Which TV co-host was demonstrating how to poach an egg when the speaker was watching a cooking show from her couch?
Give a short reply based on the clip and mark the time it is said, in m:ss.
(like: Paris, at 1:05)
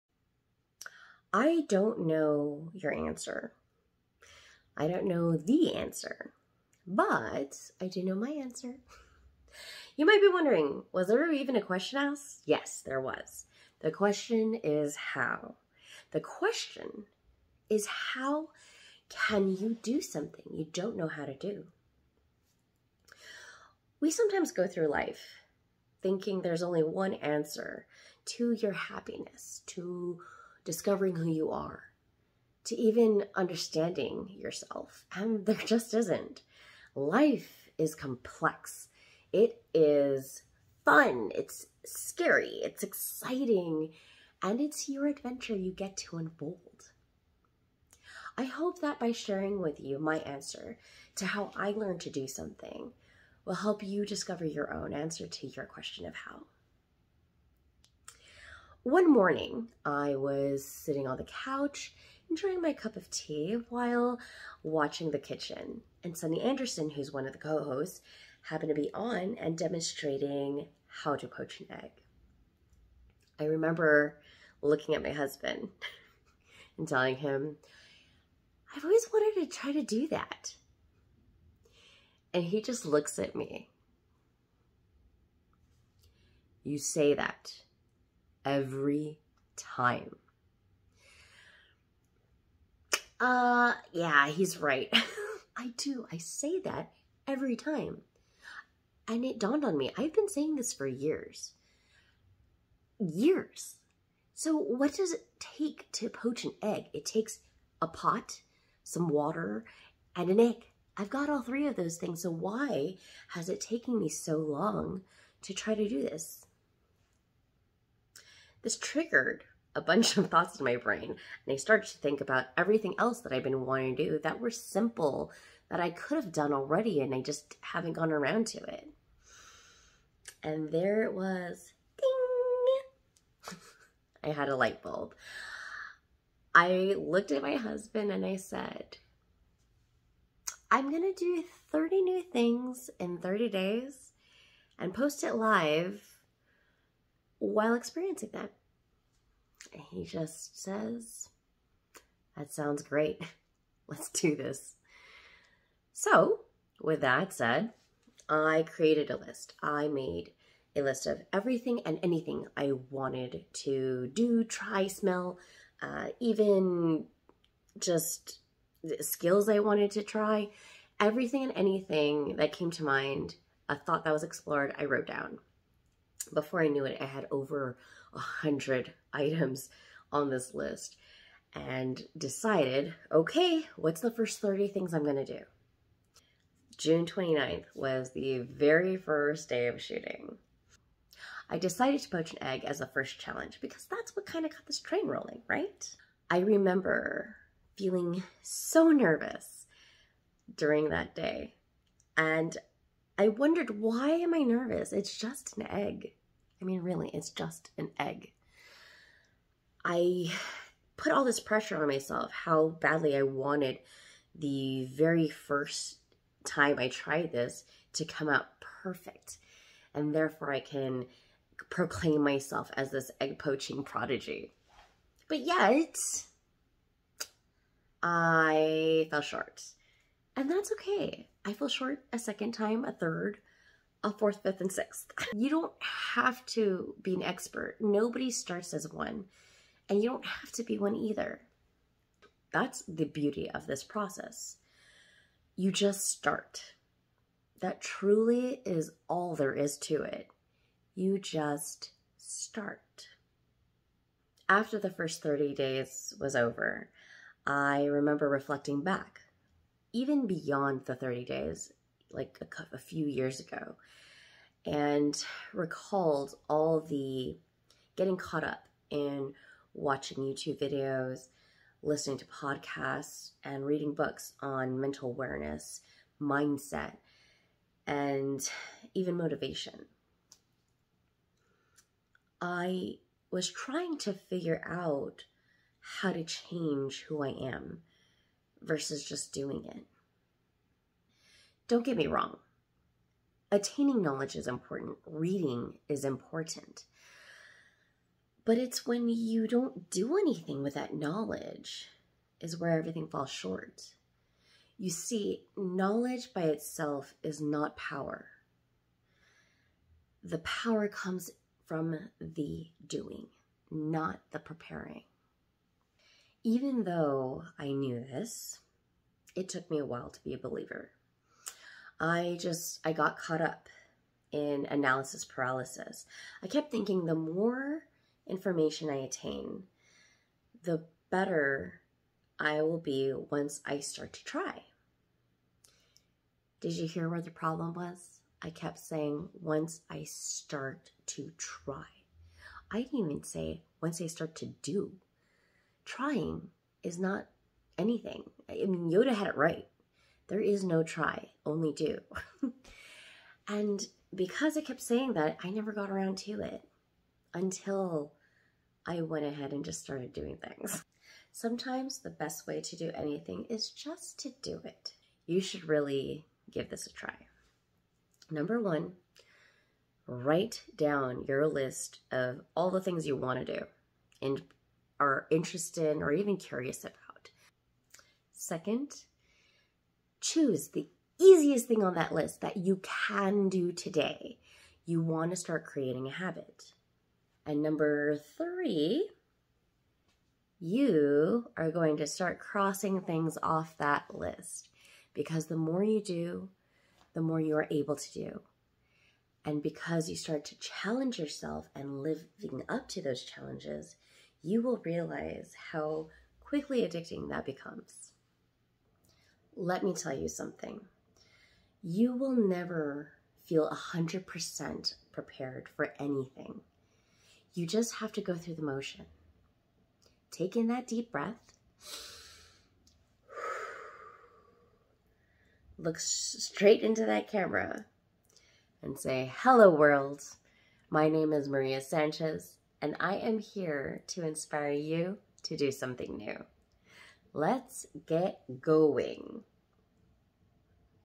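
Sunny Anderson, at 1:06.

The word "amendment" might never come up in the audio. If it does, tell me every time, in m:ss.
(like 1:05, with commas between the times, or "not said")
not said.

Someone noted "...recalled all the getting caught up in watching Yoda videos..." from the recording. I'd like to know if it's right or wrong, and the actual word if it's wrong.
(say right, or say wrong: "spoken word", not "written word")
wrong: "YouTube", not "Yoda".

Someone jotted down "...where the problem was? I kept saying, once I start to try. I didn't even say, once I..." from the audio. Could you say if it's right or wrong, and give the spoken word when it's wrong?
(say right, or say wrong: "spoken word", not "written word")
right.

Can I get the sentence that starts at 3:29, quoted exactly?
I put all this pressure on myself, how badly I wanted the very first time I tried this to come out perfect.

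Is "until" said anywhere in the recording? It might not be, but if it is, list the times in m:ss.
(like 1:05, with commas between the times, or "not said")
5:57.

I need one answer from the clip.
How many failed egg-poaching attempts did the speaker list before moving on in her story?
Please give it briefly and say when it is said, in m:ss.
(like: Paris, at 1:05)
6, at 3:54.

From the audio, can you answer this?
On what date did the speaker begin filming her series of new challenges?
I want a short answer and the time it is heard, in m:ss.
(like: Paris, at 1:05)
June 29th, at 3:06.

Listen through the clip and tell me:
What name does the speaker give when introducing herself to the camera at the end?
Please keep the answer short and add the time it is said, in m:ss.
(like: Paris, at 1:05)
Maria Sanchez, at 7:11.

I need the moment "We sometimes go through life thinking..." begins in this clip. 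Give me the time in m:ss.
0:24.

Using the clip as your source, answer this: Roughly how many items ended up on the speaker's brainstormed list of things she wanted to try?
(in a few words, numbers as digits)
Over 100.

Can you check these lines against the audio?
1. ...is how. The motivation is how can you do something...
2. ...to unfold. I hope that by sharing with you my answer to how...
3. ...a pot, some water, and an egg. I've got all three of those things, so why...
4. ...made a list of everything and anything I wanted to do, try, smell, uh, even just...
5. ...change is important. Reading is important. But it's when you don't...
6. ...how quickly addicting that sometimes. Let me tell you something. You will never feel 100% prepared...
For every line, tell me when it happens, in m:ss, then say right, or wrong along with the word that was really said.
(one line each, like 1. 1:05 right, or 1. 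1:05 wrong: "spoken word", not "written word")
1. 0:14 wrong: "question", not "motivation"
2. 0:45 right
3. 1:47 right
4. 2:39 right
5. 4:54 wrong: "knowledge", not "change"
6. 6:45 wrong: "becomes", not "sometimes".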